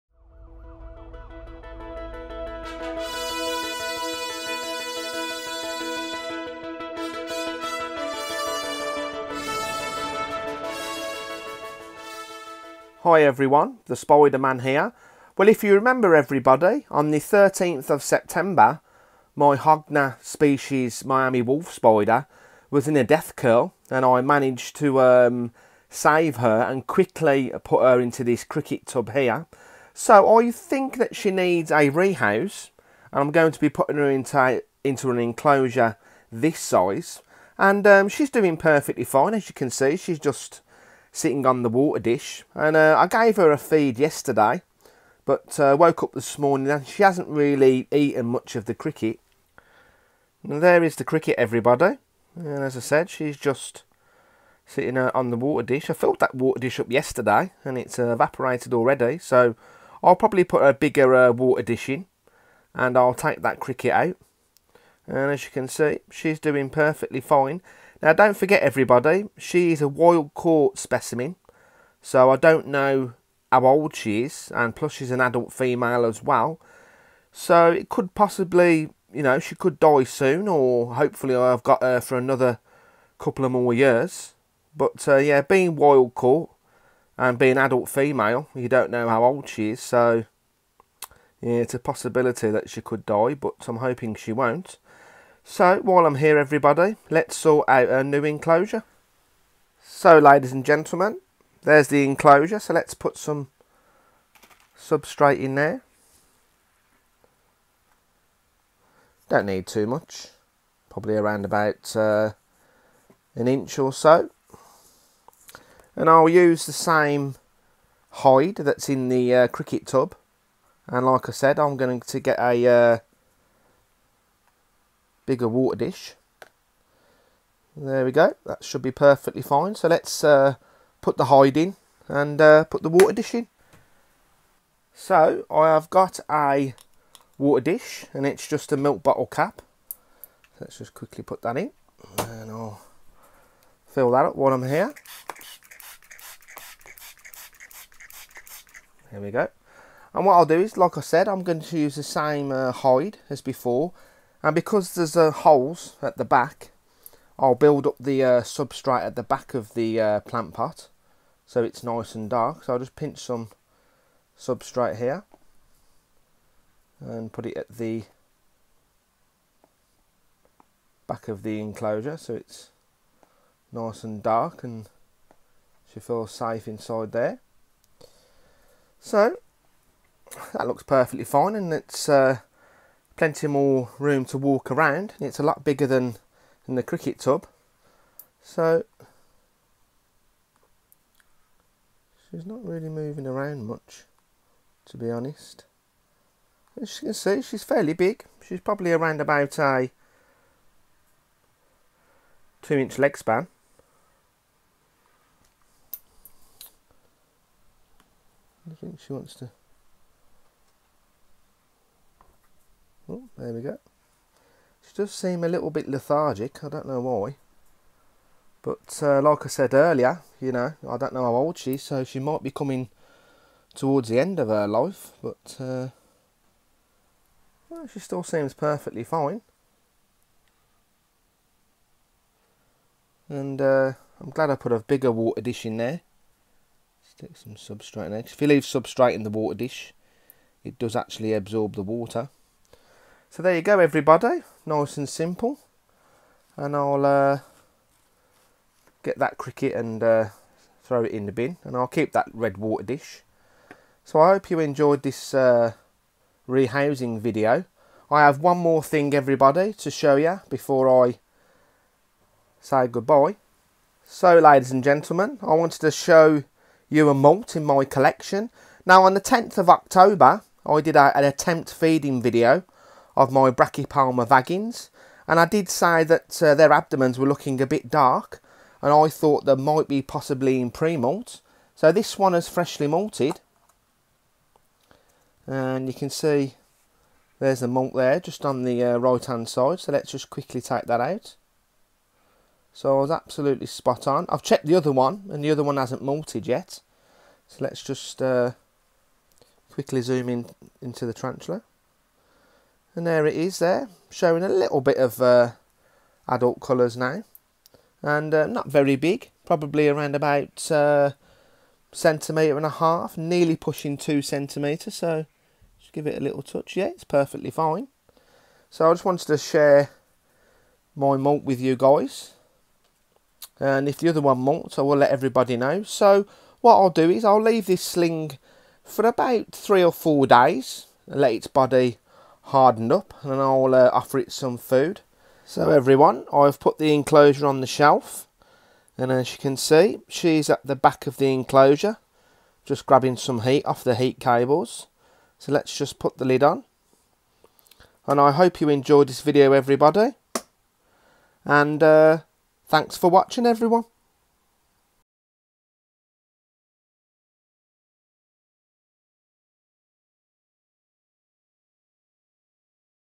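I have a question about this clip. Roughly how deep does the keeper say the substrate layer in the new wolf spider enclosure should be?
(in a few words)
an inch.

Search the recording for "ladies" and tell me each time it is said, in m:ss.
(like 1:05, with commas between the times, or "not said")
1:40, 4:24.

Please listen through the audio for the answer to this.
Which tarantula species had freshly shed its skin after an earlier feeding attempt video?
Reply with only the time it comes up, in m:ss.
4:33.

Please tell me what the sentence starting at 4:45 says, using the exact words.
And you can see there's the moult there, just on the uh, right-hand side.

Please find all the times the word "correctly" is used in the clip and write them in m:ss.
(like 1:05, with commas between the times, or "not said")
not said.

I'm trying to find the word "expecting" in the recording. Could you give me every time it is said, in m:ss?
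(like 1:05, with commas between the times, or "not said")
not said.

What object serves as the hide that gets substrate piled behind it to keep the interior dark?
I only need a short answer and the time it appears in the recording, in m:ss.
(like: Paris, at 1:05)
plant pot, at 2:40.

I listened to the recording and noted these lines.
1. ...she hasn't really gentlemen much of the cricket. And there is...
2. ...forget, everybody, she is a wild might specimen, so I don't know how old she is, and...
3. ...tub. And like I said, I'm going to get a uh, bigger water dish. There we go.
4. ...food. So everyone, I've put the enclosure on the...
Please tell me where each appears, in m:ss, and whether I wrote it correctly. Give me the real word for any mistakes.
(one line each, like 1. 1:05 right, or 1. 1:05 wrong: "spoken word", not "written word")
1. 0:46 wrong: "eaten", not "gentlemen"
2. 1:08 wrong: "caught", not "might"
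3. 1:59 right
4. 5:34 right.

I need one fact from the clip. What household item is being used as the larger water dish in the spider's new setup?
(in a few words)
milk bottle cap.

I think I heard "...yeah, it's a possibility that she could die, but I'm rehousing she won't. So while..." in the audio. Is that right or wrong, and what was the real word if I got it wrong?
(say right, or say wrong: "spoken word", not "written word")
wrong: "hoping", not "rehousing".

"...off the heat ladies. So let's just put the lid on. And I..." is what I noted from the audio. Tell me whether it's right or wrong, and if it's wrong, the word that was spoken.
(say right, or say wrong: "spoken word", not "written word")
wrong: "cables", not "ladies".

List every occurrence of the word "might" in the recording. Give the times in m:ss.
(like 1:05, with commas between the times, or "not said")
3:42, 4:39.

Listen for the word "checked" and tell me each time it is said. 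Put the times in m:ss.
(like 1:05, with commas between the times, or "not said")
4:54.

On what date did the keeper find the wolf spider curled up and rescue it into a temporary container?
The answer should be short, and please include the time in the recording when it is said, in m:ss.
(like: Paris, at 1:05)
13th of September, at 0:17.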